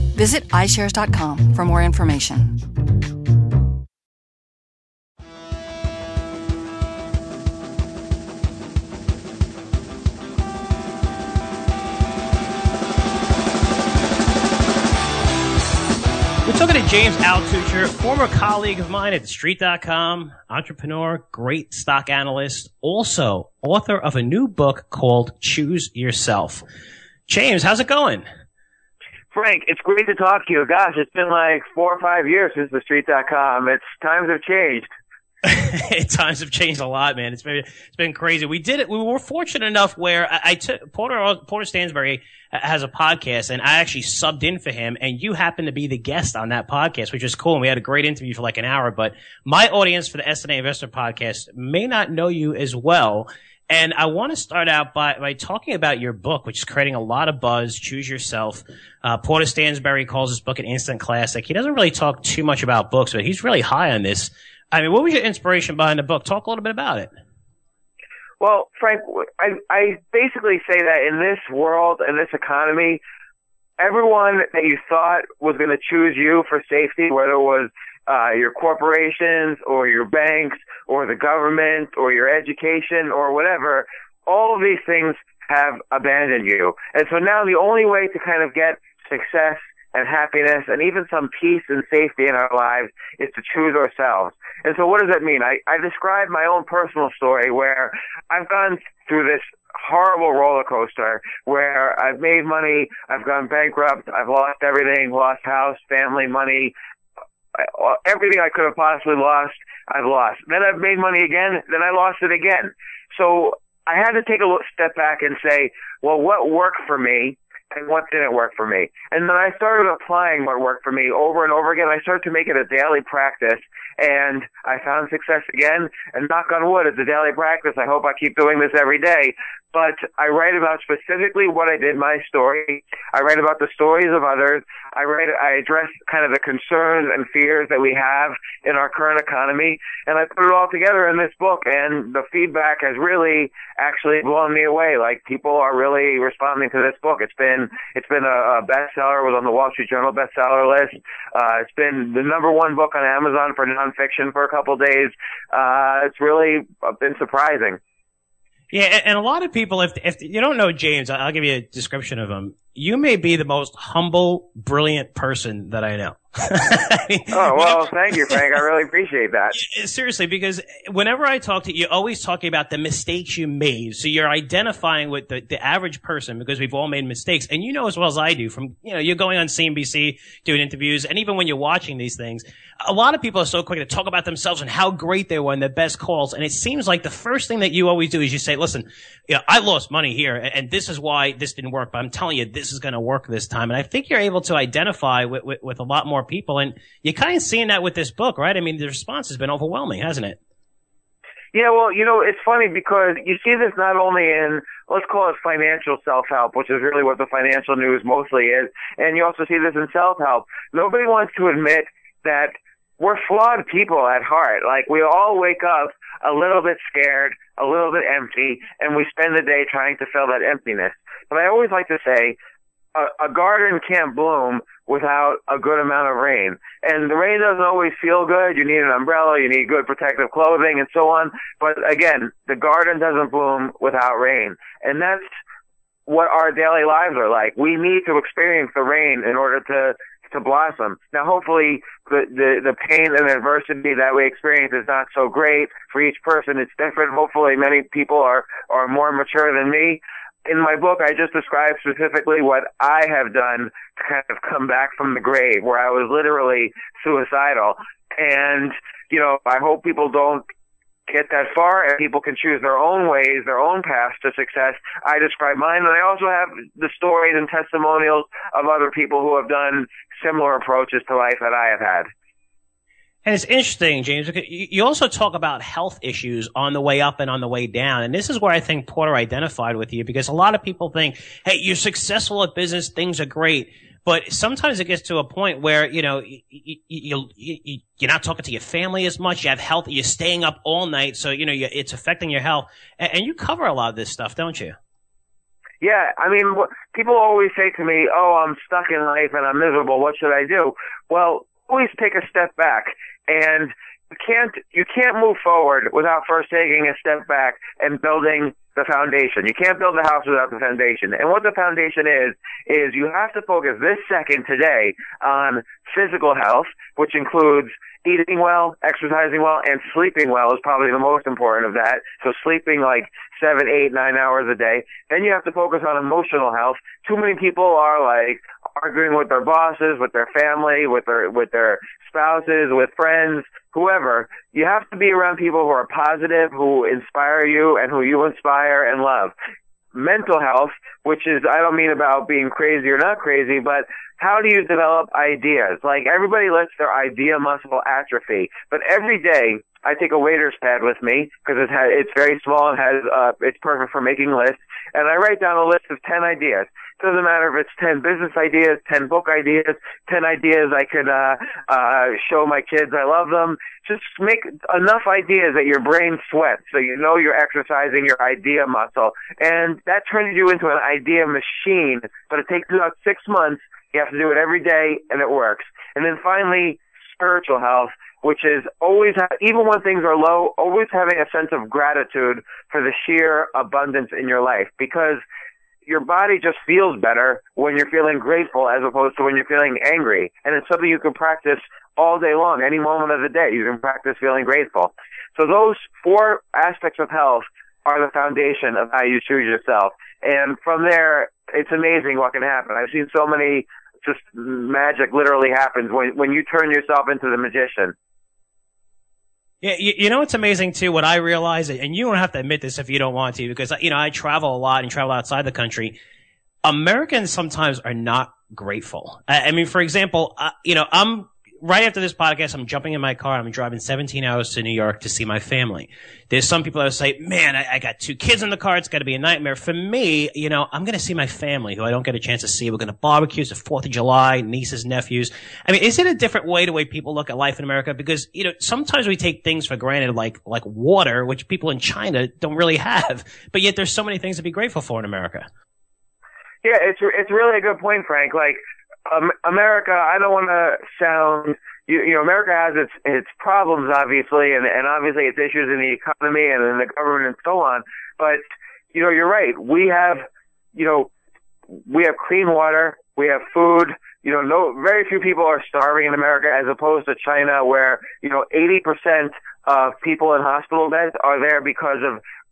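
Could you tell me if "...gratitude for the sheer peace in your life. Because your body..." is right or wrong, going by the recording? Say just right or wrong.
wrong.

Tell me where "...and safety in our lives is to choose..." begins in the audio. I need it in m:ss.
1:31.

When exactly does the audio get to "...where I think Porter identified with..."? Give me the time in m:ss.
4:38.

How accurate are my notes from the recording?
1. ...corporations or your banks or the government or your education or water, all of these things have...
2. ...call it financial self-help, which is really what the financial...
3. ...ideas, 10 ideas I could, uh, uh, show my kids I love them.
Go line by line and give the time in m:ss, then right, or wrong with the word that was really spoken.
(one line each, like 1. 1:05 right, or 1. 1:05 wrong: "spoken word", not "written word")
1. 1:18 wrong: "whatever", not "water"
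2. 3:25 right
3. 5:59 right.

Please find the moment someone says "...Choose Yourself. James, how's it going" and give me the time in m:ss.
0:25.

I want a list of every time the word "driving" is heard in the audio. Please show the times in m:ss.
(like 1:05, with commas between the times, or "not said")
7:03.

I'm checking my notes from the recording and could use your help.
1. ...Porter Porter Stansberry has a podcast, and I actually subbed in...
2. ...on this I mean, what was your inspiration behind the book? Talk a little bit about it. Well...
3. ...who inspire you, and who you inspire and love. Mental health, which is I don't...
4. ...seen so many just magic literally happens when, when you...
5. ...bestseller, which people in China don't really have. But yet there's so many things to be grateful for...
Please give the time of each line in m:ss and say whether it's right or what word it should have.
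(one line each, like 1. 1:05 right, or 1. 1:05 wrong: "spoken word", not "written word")
1. 0:40 right
2. 1:03 right
3. 5:36 right
4. 6:42 right
5. 7:20 wrong: "water", not "bestseller".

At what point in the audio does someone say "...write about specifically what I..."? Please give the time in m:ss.
2:10.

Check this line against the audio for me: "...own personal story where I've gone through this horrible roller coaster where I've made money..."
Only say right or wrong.
right.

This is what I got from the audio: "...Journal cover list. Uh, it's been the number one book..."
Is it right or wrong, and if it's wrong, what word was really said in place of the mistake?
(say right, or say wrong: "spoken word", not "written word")
wrong: "bestseller", not "cover".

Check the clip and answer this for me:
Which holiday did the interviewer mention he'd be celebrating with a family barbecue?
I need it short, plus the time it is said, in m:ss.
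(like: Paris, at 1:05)
4th of July, at 7:13.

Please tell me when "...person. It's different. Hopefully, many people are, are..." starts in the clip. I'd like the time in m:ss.
4:06.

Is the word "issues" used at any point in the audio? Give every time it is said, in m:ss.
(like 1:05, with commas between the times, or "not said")
4:36, 7:35.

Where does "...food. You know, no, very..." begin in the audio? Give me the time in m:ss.
7:43.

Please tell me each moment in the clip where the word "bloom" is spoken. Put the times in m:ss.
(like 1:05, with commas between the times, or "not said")
3:44, 3:53.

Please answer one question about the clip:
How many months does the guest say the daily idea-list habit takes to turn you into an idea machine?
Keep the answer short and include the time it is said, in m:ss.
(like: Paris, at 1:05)
6, at 6:13.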